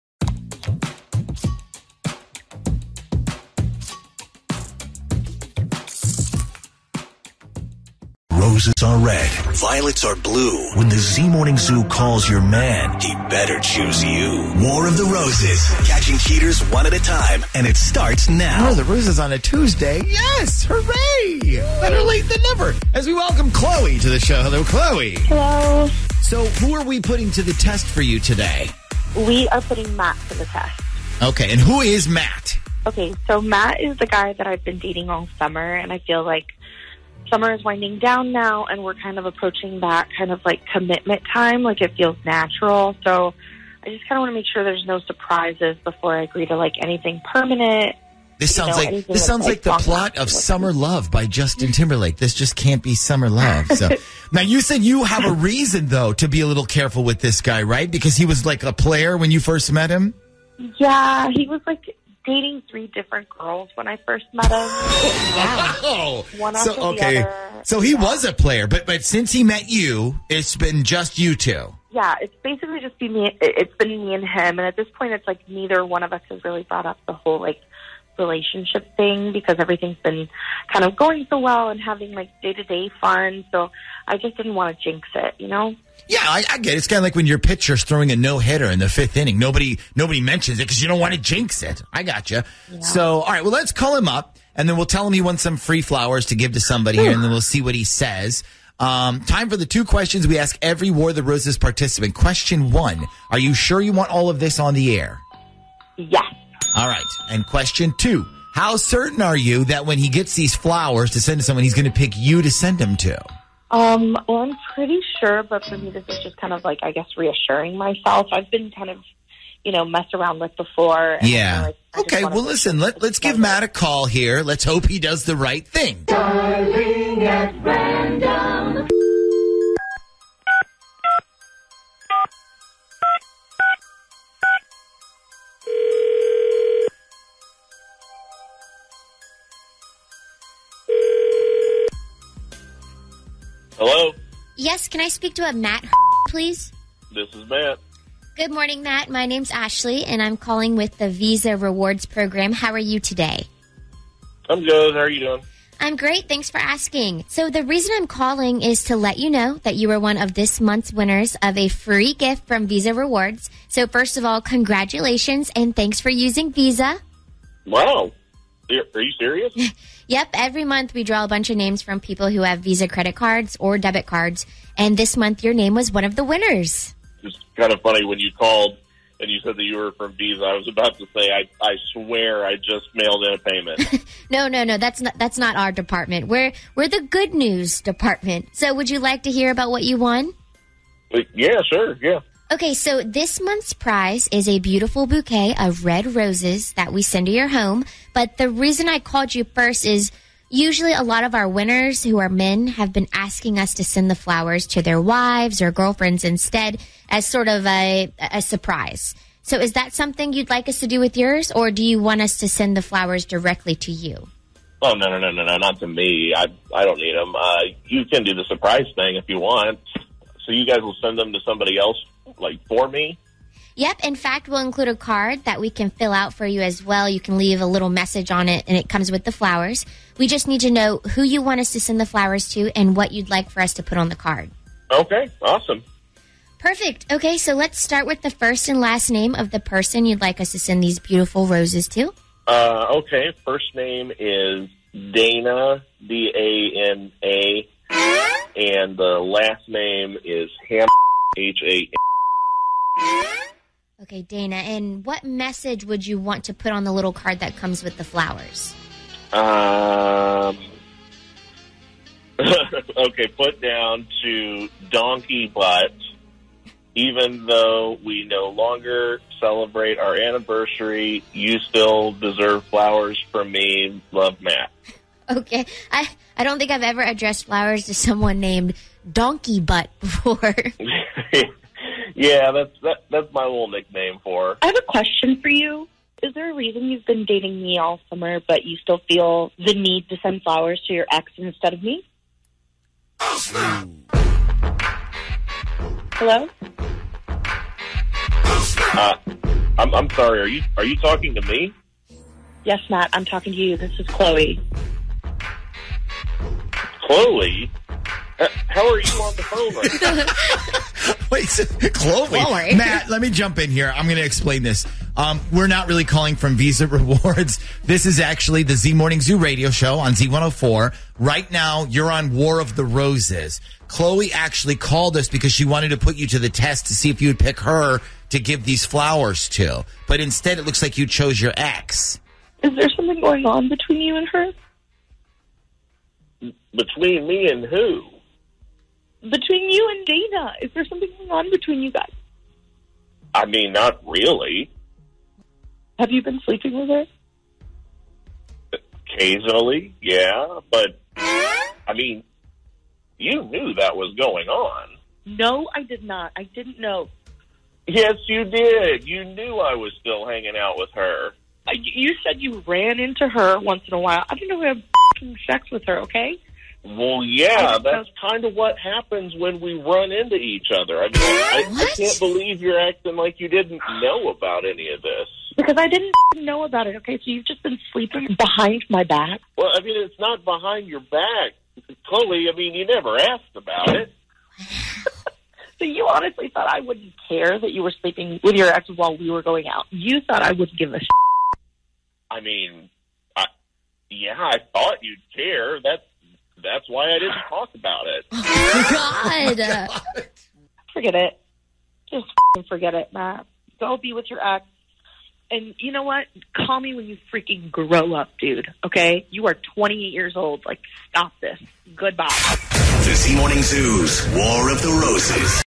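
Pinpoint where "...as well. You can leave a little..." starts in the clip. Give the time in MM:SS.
03:46.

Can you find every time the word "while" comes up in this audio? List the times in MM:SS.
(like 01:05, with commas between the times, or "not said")
06:03, 06:28.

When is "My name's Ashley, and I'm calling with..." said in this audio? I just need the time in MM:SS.
02:29.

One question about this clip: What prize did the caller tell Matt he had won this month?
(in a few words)
Red roses.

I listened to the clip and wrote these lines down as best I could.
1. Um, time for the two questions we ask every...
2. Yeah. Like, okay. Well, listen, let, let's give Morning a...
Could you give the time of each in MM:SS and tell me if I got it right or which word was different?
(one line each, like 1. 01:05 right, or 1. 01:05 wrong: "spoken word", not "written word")
1. 01:38 right
2. 02:01 wrong: "Matt", not "Morning".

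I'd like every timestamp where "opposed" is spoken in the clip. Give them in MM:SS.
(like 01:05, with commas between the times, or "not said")
not said.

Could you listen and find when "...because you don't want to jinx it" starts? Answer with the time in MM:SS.
01:30.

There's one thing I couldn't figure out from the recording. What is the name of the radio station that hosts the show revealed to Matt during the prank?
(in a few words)
Z104.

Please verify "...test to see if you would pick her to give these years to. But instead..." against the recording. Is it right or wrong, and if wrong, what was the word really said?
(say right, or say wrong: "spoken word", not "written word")
wrong: "flowers", not "years".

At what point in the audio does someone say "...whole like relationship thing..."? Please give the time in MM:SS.
01:17.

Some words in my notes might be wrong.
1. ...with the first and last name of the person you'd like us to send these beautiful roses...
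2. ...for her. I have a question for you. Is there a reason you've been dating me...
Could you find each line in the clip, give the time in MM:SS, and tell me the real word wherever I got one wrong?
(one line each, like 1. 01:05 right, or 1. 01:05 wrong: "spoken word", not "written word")
1. 03:58 right
2. 04:44 right.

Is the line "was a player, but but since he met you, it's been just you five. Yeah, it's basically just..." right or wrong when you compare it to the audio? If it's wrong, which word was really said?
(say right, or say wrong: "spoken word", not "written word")
wrong: "two", not "five".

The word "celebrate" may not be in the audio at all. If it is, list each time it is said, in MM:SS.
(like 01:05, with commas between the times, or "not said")
04:29.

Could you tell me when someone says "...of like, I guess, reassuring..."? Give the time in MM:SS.
01:56.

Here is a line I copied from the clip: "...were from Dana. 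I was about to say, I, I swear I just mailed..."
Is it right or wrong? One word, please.
wrong.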